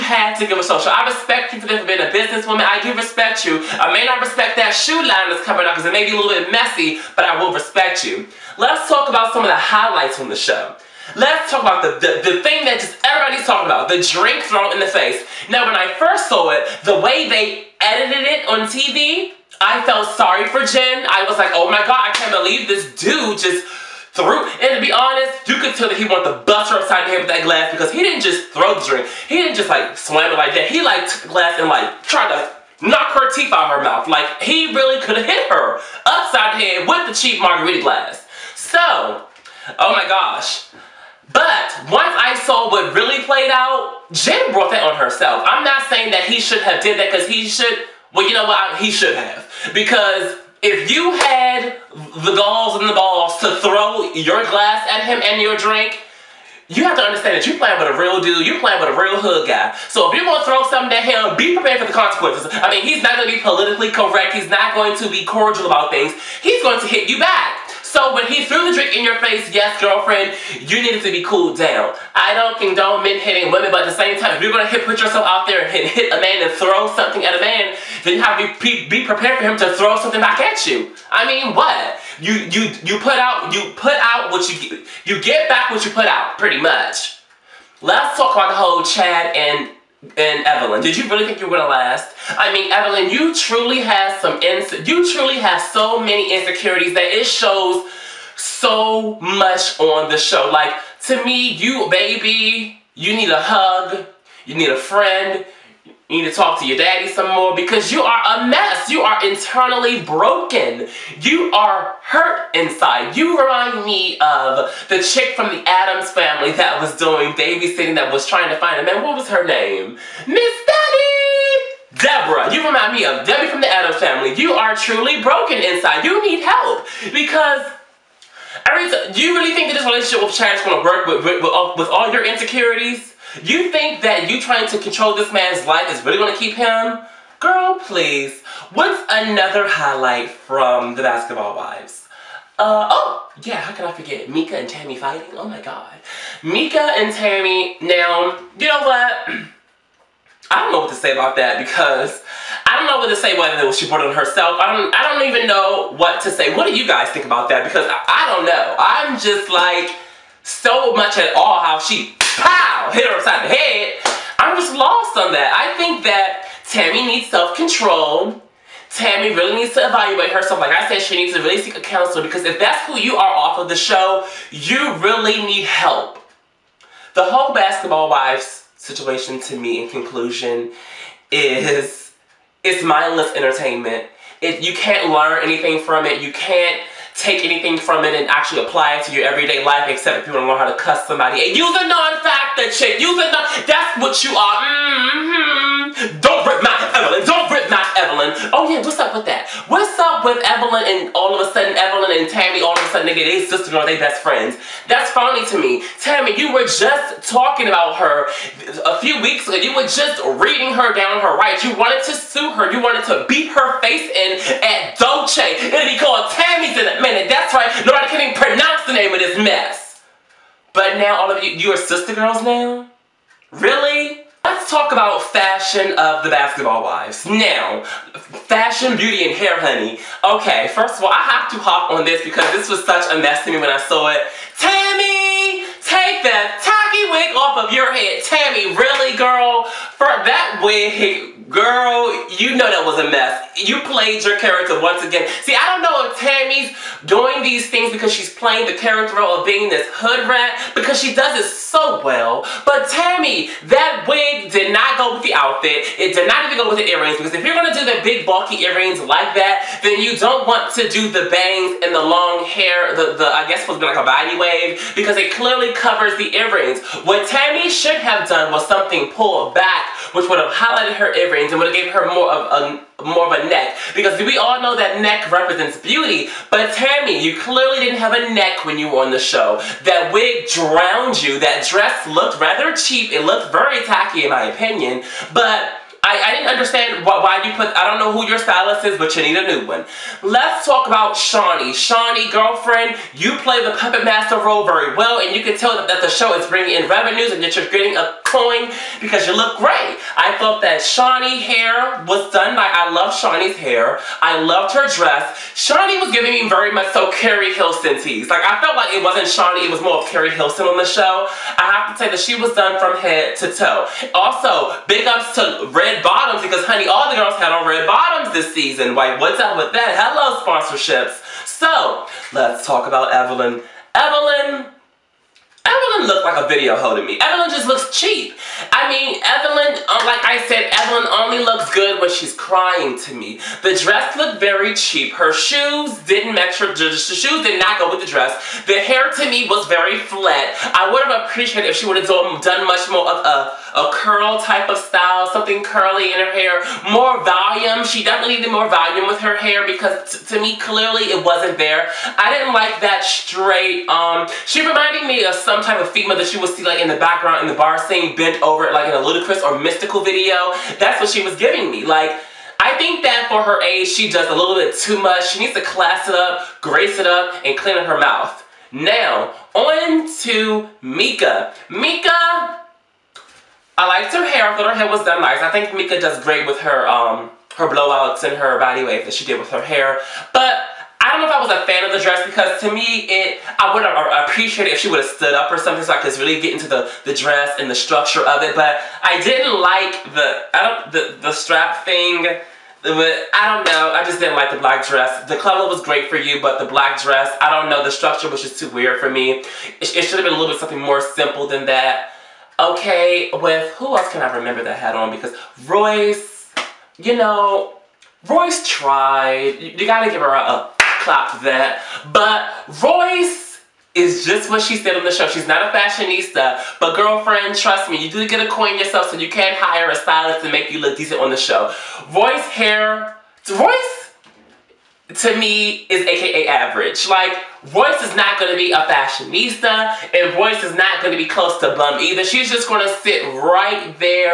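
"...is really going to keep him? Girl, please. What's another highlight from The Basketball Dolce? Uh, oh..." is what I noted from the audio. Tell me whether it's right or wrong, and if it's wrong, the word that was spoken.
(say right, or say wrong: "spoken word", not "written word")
wrong: "Wives", not "Dolce".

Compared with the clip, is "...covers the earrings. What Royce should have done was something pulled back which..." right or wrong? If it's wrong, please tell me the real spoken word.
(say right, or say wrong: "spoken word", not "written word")
wrong: "Tami", not "Royce".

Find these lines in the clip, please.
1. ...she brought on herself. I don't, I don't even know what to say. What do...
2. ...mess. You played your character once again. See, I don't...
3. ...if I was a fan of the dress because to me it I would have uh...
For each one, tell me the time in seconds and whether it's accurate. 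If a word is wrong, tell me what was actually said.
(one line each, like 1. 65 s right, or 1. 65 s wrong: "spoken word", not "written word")
1. 153 s right
2. 243 s right
3. 381 s right.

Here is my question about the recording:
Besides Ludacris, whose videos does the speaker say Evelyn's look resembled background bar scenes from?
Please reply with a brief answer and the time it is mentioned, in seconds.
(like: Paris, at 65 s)
Mystikal, at 359 s.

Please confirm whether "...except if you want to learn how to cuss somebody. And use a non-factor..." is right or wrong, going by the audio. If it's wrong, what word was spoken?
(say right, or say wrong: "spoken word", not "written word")
right.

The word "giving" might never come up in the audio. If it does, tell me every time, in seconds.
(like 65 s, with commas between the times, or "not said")
306 s, 361 s.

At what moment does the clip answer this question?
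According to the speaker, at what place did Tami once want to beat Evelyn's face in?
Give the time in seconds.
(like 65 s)
214 s.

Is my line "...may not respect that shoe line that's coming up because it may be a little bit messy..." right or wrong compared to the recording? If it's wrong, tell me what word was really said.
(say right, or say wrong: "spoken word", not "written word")
right.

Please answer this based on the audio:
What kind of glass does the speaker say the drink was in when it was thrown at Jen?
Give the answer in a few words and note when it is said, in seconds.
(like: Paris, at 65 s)
cheap margarita glass, at 37 s.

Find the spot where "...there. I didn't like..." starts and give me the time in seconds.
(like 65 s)
351 s.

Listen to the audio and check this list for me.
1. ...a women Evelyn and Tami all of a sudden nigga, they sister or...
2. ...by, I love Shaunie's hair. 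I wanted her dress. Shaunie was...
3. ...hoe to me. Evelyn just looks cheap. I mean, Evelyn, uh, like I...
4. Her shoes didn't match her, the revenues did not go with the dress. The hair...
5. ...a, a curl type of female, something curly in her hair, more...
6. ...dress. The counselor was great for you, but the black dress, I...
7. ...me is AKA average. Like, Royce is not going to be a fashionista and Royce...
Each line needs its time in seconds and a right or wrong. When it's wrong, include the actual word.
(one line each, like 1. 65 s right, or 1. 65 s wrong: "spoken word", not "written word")
1. 201 s wrong: "sudden", not "women"
2. 302 s wrong: "loved", not "wanted"
3. 326 s right
4. 335 s wrong: "shoes", not "revenues"
5. 343 s wrong: "style", not "female"
6. 394 s wrong: "color", not "counselor"
7. 425 s right.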